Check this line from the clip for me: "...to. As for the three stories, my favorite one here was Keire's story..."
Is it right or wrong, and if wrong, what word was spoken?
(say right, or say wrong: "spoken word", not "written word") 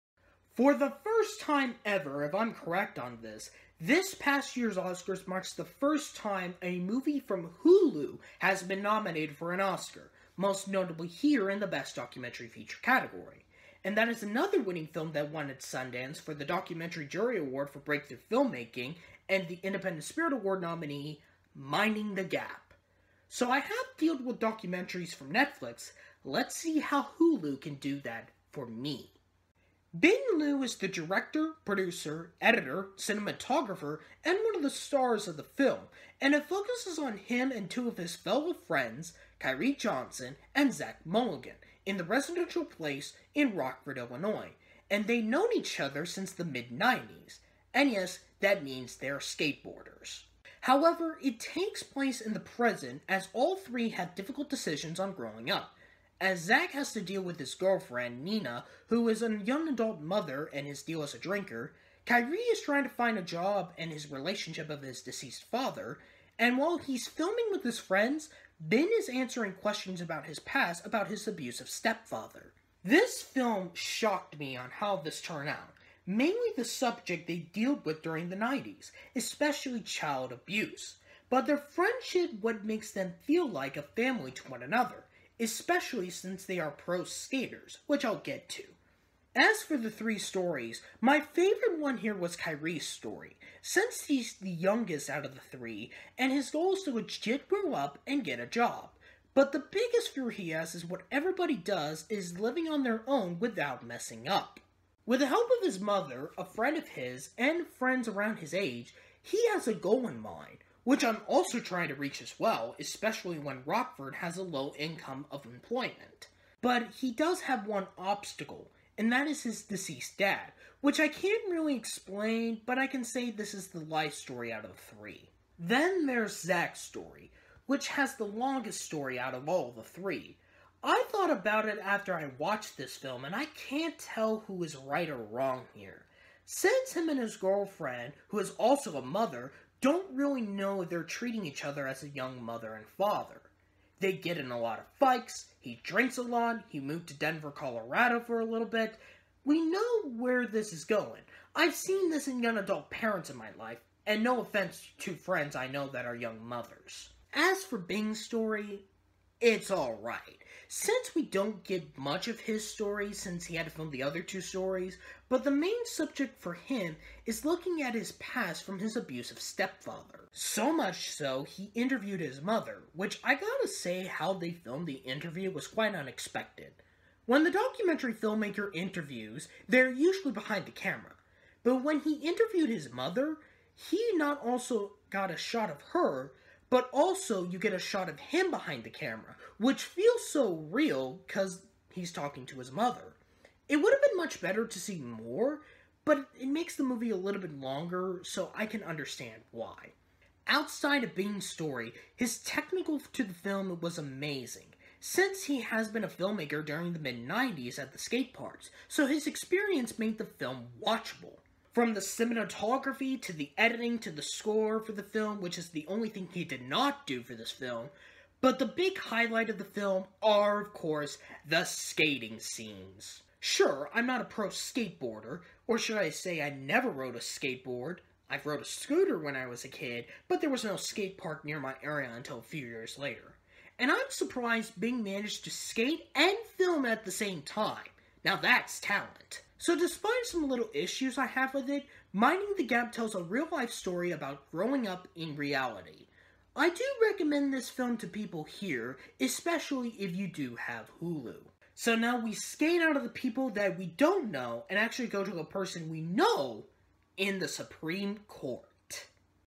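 right.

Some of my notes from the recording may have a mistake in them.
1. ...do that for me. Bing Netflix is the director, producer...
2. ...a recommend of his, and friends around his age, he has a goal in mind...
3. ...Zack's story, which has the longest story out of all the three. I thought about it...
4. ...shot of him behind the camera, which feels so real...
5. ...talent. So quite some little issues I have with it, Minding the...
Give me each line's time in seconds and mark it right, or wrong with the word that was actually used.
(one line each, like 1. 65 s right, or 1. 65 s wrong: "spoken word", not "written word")
1. 27 s wrong: "Liu", not "Netflix"
2. 106 s wrong: "friend", not "recommend"
3. 126 s right
4. 187 s right
5. 238 s wrong: "despite", not "quite".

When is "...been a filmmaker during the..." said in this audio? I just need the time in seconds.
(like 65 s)
205 s.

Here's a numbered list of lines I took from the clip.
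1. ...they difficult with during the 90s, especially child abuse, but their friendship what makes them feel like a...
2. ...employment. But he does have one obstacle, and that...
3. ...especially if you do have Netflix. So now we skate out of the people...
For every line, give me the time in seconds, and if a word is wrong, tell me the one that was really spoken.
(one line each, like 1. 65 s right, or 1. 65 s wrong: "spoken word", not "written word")
1. 77 s wrong: "dealt", not "difficult"
2. 115 s right
3. 249 s wrong: "Hulu", not "Netflix".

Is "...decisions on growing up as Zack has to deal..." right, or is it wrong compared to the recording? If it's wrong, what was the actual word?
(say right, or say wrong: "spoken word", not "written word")
right.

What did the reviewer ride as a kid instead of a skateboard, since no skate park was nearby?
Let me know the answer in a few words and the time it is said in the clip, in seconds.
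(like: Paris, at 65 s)
A scooter, at 228 s.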